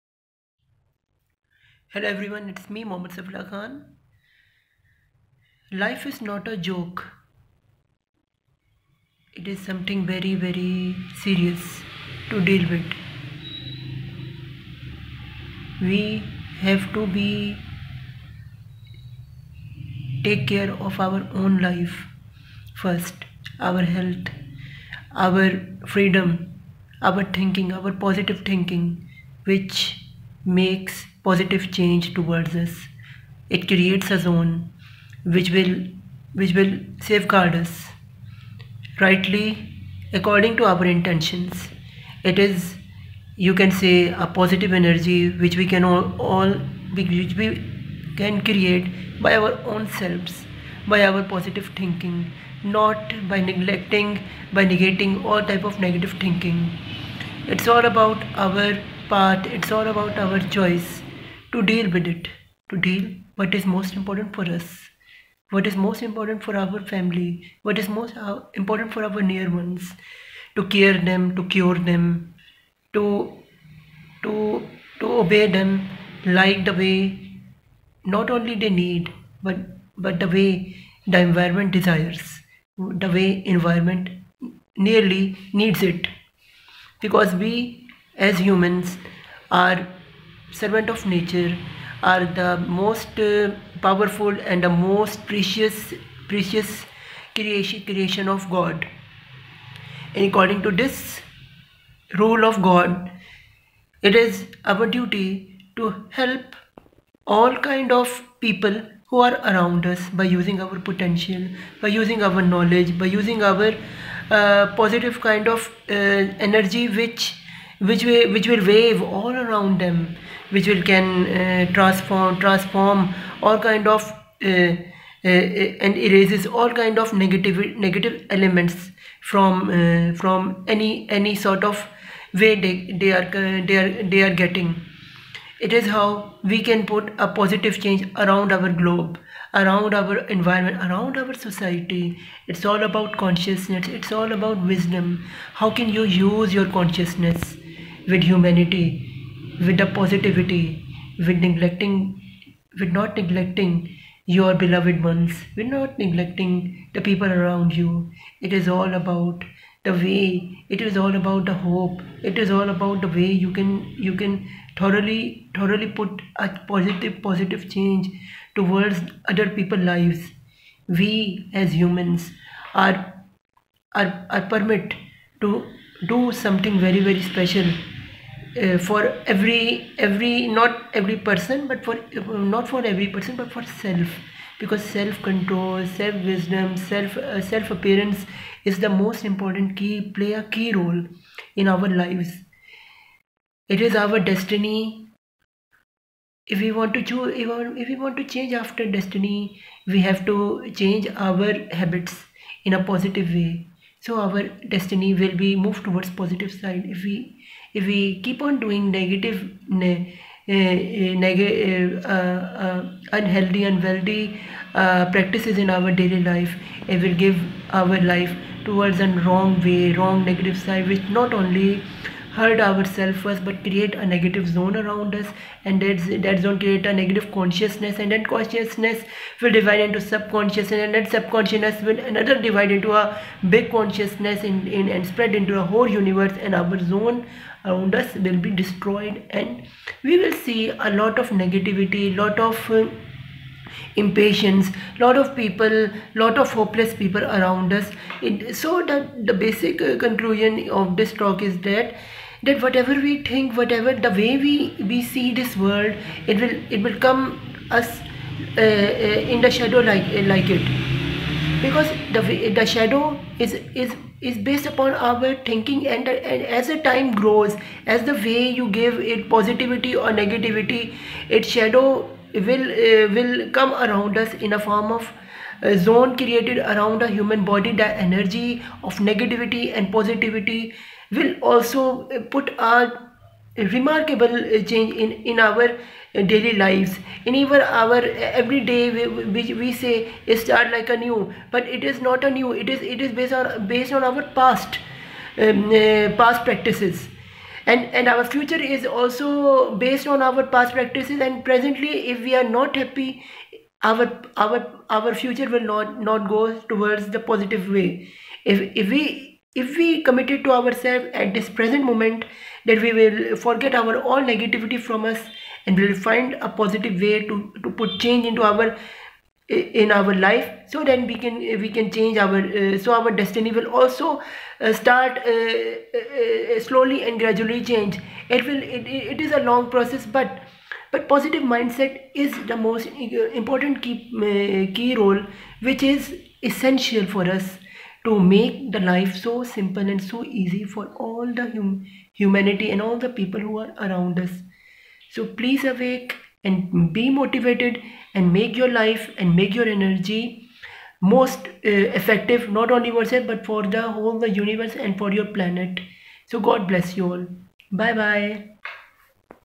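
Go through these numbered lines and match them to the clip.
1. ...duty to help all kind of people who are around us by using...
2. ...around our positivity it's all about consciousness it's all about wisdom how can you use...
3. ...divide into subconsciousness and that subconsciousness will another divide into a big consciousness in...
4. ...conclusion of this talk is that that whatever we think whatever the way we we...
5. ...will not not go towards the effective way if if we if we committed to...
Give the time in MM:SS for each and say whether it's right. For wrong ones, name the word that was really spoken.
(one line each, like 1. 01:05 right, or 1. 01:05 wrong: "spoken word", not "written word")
1. 01:44 right
2. 02:20 wrong: "society", not "positivity"
3. 03:49 right
4. 04:09 right
5. 05:05 wrong: "positive", not "effective".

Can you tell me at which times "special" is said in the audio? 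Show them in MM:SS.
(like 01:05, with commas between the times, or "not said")
02:57.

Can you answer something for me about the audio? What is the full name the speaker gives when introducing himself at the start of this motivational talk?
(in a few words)
Muhammad Safi Ullah Khan.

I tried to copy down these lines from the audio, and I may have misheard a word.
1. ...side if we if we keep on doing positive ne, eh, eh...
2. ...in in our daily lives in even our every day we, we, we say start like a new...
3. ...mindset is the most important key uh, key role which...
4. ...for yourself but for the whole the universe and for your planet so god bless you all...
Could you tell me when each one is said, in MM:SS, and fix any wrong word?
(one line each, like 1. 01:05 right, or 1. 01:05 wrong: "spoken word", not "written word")
1. 03:26 wrong: "negative", not "positive"
2. 04:44 right
3. 05:31 right
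4. 05:52 right.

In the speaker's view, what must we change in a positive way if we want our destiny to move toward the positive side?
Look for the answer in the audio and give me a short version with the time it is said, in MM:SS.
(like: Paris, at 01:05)
our habits, at 03:21.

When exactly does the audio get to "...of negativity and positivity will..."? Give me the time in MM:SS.
04:38.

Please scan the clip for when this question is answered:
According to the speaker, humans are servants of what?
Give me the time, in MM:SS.
01:31.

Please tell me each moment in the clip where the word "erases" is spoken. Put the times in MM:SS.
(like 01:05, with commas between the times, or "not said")
02:05.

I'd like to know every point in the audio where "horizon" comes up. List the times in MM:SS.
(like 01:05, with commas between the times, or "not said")
not said.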